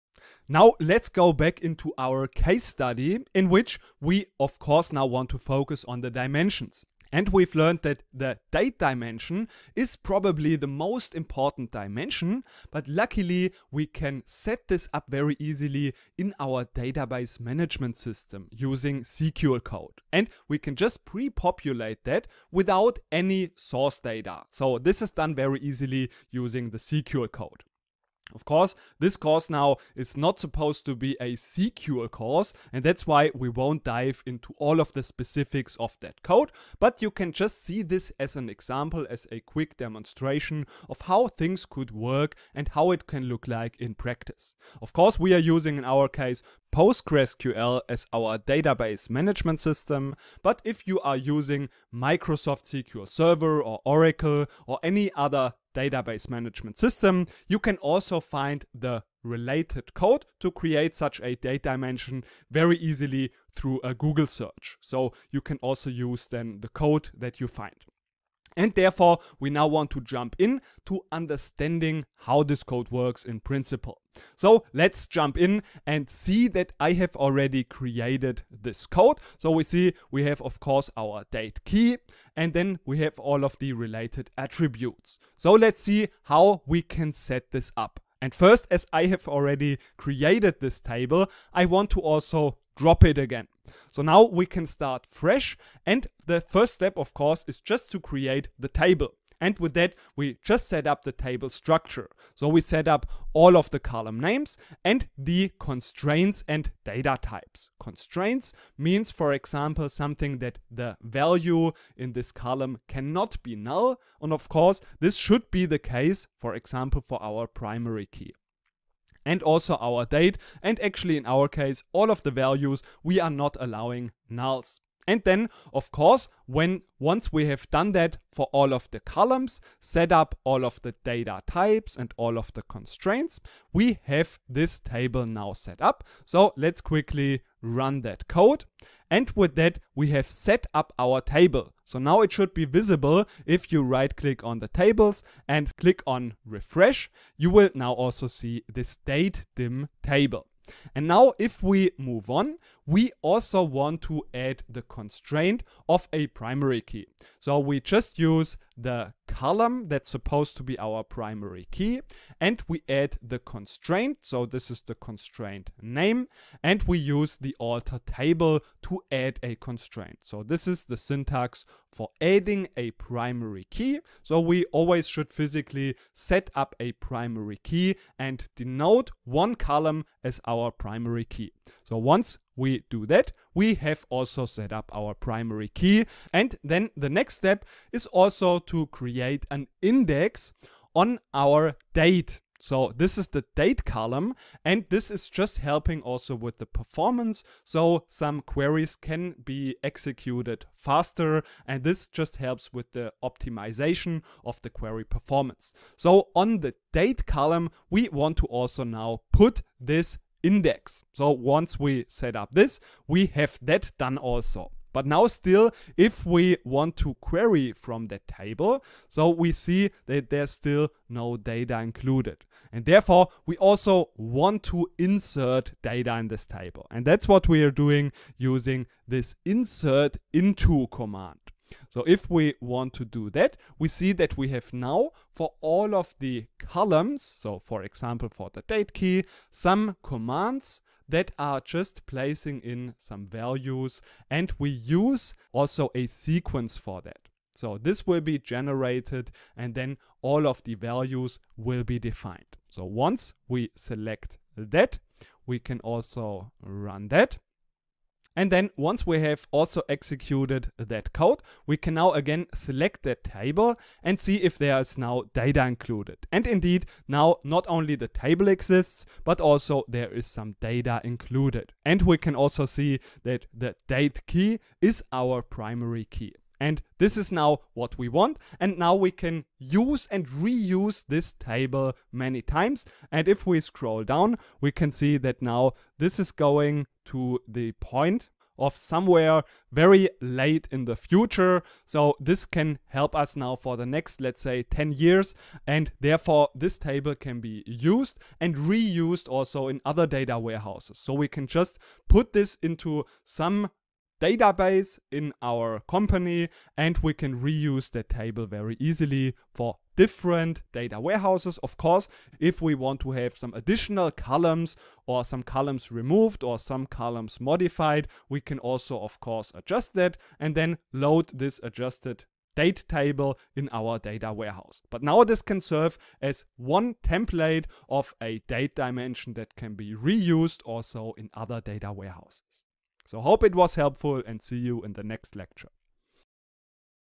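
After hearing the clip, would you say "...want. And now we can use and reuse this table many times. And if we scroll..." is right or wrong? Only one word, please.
right.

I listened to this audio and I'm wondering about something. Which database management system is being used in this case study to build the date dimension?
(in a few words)
PostgreSQL.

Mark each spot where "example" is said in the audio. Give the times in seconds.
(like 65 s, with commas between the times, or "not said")
38 s, 109 s, 116 s, 237 s.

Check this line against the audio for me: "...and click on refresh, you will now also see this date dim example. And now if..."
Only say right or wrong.
wrong.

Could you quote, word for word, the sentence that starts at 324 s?
But now this can serve as one template of a date dimension that can be reused also in other data warehouses.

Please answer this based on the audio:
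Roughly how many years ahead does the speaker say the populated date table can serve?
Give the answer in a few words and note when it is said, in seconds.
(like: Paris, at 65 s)
10 years, at 294 s.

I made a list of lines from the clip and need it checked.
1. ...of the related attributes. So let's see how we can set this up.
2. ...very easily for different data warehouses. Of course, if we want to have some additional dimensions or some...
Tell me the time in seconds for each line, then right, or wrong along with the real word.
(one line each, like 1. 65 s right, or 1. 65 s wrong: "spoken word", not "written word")
1. 83 s right
2. 308 s wrong: "columns", not "dimensions".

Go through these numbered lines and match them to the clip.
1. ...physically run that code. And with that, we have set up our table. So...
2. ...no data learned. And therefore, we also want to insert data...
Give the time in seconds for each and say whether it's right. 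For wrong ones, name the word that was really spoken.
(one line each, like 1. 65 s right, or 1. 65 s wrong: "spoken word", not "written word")
1. 136 s wrong: "quickly", not "physically"
2. 221 s wrong: "included", not "learned".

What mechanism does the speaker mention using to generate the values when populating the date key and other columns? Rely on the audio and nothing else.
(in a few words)
A sequence.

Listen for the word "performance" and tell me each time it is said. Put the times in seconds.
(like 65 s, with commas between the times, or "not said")
196 s, 205 s.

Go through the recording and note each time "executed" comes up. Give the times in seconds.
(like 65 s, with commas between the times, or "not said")
199 s, 259 s.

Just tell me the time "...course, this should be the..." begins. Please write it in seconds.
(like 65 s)
114 s.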